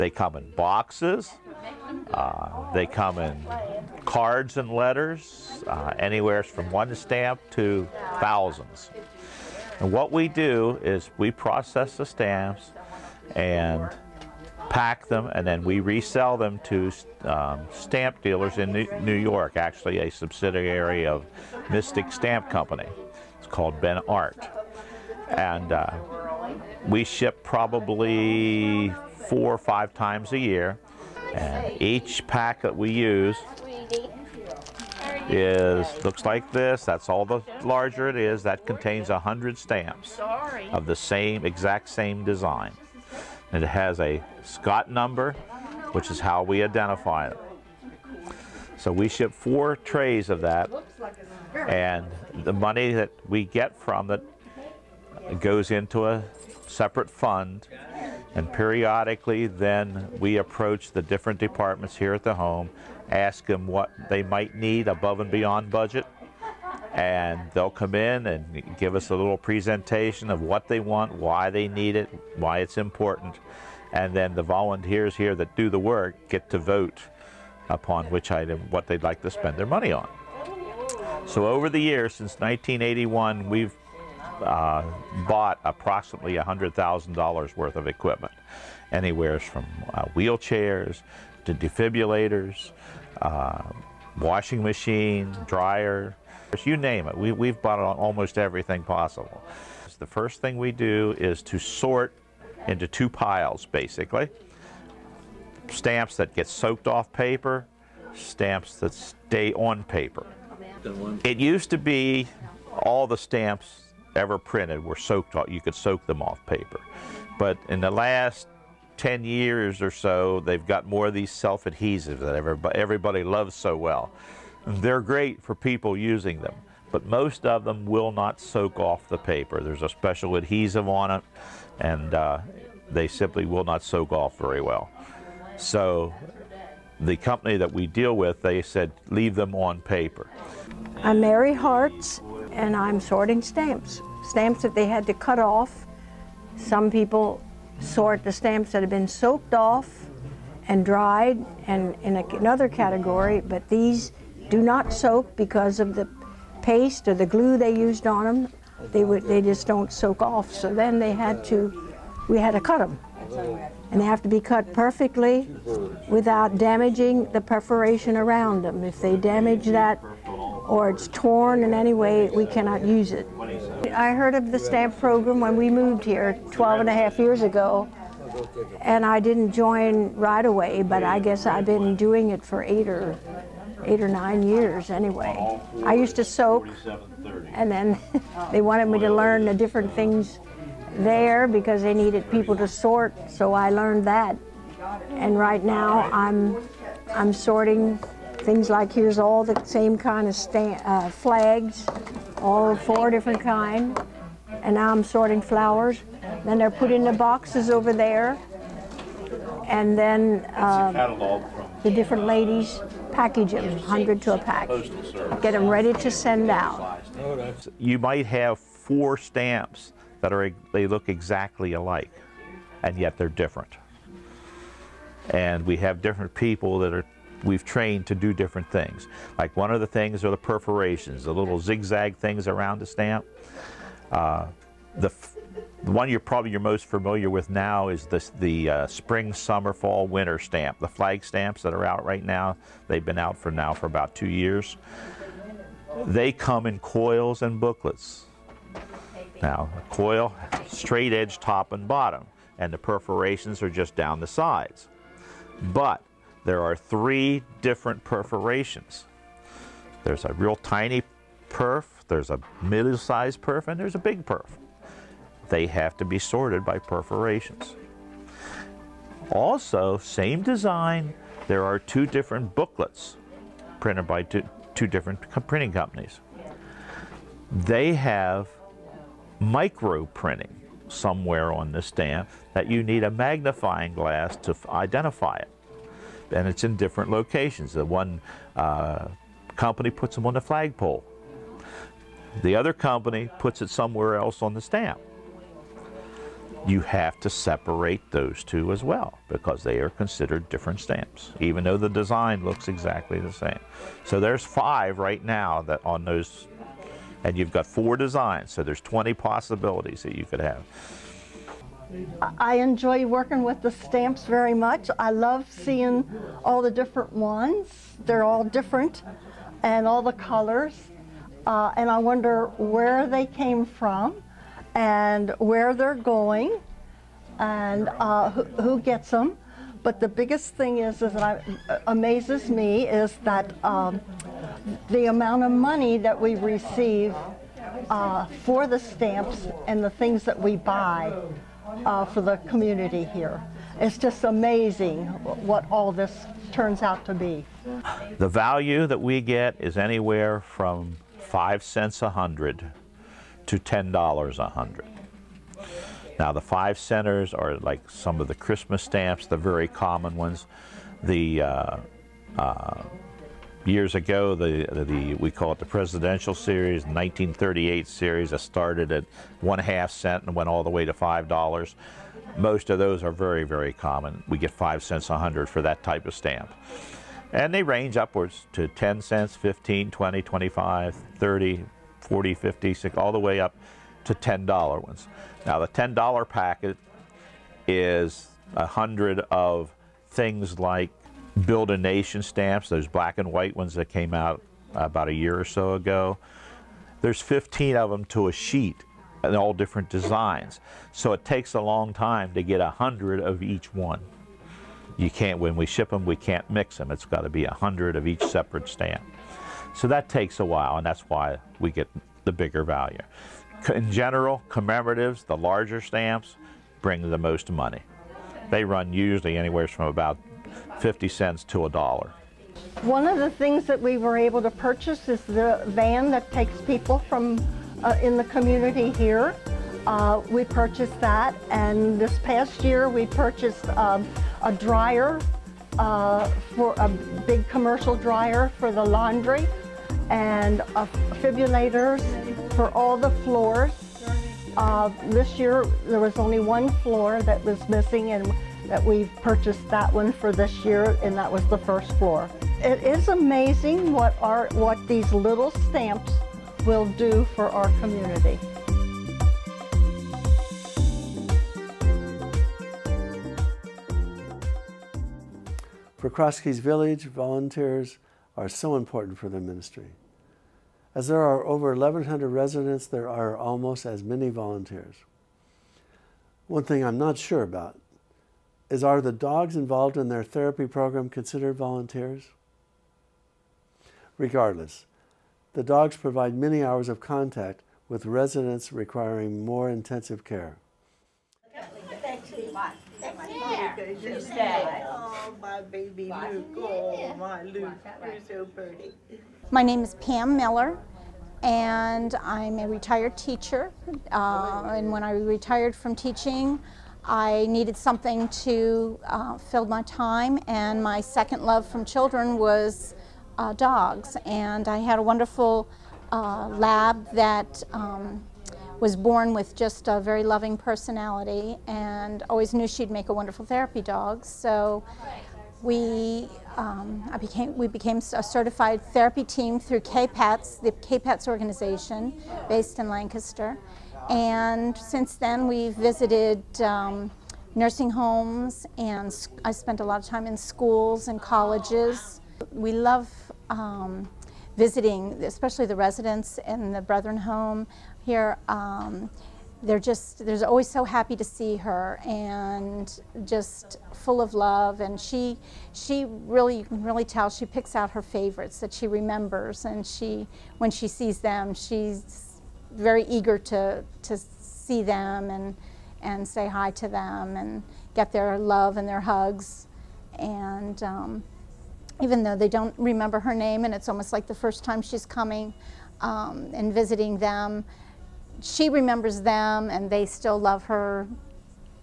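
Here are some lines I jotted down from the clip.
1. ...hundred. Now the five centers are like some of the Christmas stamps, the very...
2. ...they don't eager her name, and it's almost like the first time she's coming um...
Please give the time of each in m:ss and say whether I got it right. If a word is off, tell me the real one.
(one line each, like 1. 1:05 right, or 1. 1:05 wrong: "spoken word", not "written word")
1. 5:54 right
2. 9:32 wrong: "remember", not "eager".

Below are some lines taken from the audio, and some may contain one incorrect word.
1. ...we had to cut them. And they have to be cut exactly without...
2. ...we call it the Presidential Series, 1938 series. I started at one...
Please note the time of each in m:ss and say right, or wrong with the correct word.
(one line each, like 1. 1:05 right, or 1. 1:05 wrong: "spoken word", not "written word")
1. 2:42 wrong: "perfectly", not "exactly"
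2. 6:05 right.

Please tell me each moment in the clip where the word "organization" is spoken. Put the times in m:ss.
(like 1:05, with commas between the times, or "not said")
8:51.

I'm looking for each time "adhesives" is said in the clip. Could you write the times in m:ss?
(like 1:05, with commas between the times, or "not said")
2:01, 2:10.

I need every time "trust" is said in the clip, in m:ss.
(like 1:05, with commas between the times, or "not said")
not said.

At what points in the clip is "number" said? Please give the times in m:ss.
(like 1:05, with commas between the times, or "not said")
0:44.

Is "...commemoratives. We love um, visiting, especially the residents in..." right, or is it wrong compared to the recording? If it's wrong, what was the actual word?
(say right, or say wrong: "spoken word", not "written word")
wrong: "colleges", not "commemoratives".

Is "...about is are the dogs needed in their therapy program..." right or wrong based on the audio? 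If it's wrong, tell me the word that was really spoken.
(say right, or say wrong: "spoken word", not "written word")
wrong: "involved", not "needed".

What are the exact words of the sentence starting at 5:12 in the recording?
I enjoy working with the stamps very much.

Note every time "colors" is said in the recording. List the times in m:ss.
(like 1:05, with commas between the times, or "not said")
5:20.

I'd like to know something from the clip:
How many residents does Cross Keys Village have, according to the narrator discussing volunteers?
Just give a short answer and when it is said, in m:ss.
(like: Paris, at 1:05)
over 1,100, at 7:51.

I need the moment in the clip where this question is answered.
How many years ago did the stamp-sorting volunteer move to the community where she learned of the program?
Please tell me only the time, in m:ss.
2:56.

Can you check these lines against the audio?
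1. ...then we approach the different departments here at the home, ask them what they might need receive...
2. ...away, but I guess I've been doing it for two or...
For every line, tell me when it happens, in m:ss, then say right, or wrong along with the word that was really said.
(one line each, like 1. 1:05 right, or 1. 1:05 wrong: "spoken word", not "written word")
1. 0:59 wrong: "above", not "receive"
2. 3:00 wrong: "eight", not "two".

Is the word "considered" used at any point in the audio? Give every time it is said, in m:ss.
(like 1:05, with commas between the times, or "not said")
4:59, 8:01.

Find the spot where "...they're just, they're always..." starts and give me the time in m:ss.
9:09.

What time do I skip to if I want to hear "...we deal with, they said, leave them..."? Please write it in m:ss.
2:17.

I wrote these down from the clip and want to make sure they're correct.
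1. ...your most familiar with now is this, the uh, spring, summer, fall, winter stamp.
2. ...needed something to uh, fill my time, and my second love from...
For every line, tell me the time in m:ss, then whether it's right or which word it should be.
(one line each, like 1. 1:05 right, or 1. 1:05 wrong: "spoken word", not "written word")
1. 3:56 right
2. 8:27 right.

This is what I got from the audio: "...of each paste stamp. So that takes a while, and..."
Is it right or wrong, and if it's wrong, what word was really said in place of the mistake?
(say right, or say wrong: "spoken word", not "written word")
wrong: "separate", not "paste".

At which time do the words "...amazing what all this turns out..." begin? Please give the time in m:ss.
5:44.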